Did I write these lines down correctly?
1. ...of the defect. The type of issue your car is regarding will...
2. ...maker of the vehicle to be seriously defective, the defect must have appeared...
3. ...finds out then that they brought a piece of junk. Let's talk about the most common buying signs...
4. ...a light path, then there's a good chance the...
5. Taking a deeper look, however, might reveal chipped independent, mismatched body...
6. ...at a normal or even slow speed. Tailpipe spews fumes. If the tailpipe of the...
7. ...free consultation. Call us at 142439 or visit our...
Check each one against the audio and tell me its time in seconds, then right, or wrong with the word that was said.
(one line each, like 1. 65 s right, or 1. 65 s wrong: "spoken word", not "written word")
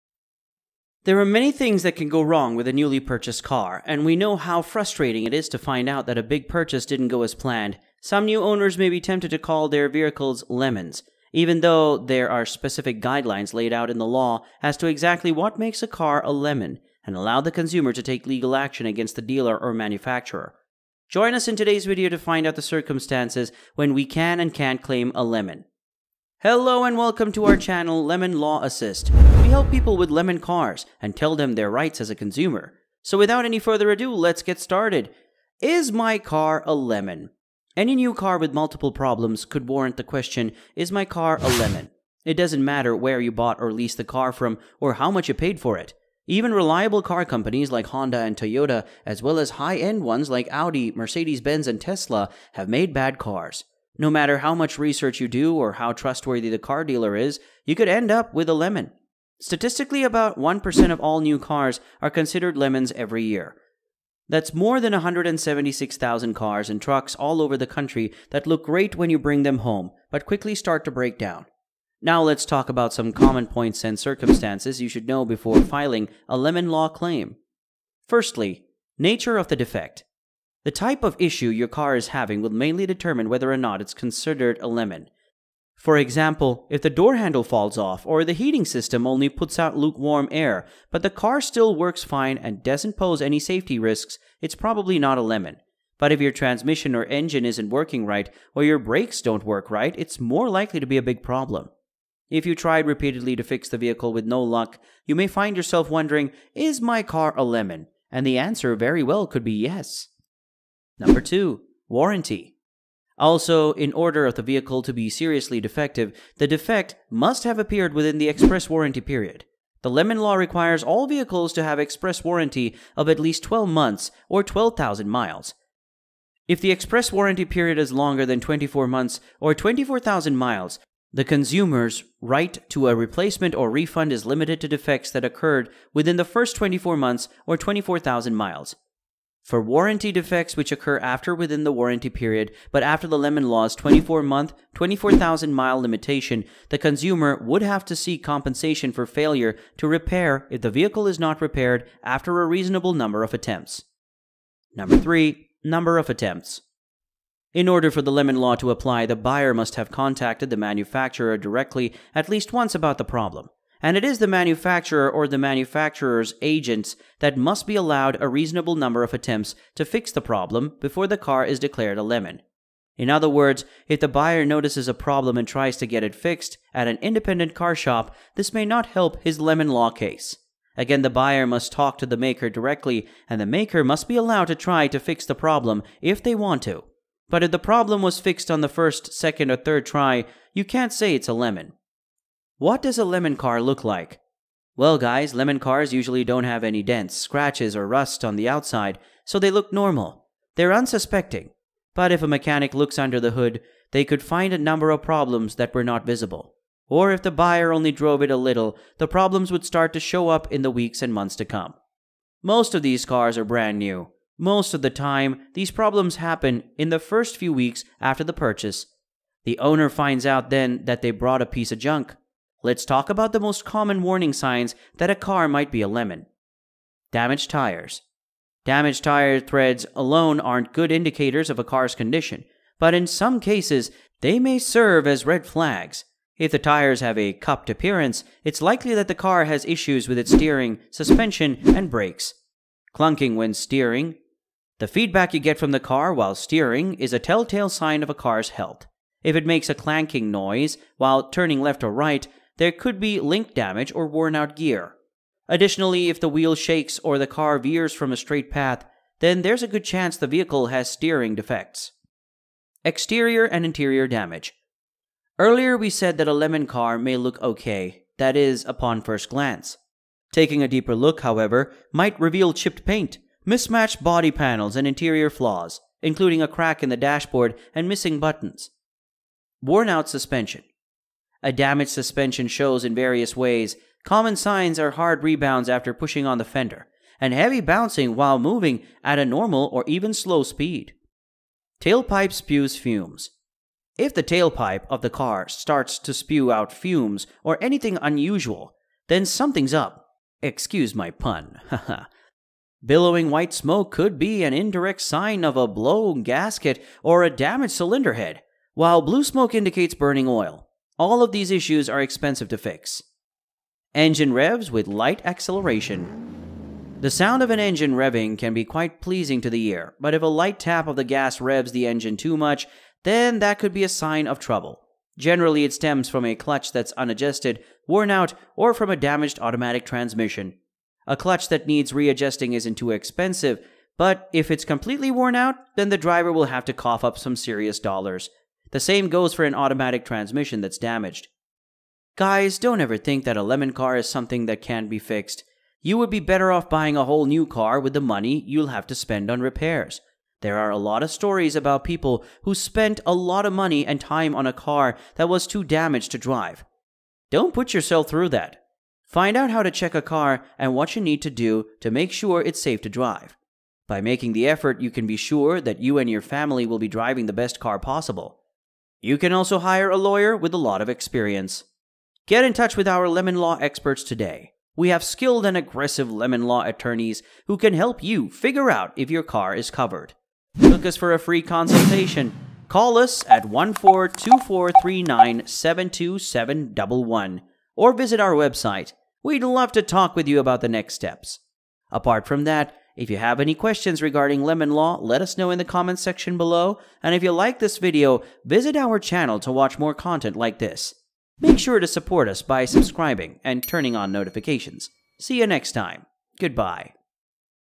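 1. 79 s wrong: "having", not "regarding"
2. 113 s wrong: "order", not "maker"
3. 219 s wrong: "warning", not "buying"
4. 258 s wrong: "straight", not "light"
5. 270 s wrong: "paint", not "independent"
6. 289 s right
7. 381 s right.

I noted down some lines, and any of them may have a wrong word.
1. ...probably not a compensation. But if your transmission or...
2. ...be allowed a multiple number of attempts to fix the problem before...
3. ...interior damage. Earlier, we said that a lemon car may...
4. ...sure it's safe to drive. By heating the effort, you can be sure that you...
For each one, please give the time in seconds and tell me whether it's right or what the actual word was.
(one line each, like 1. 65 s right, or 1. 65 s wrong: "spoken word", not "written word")
1. 94 s wrong: "lemon", not "compensation"
2. 167 s wrong: "reasonable", not "multiple"
3. 263 s right
4. 362 s wrong: "making", not "heating".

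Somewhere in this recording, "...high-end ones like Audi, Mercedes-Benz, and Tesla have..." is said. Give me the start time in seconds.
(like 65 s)
49 s.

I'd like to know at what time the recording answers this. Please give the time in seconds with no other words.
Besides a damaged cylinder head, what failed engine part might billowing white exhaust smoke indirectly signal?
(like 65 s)
305 s.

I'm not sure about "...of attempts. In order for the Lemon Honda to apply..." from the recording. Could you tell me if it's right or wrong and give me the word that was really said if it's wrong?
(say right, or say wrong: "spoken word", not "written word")
wrong: "Law", not "Honda".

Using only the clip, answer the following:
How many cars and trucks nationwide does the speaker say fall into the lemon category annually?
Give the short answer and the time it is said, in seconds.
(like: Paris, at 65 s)
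176,000, at 64 s.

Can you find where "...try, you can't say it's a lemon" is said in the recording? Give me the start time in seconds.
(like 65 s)
189 s.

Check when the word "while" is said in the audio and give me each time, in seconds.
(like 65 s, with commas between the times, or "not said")
246 s, 250 s, 288 s, 308 s.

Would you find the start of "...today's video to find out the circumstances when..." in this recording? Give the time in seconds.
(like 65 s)
21 s.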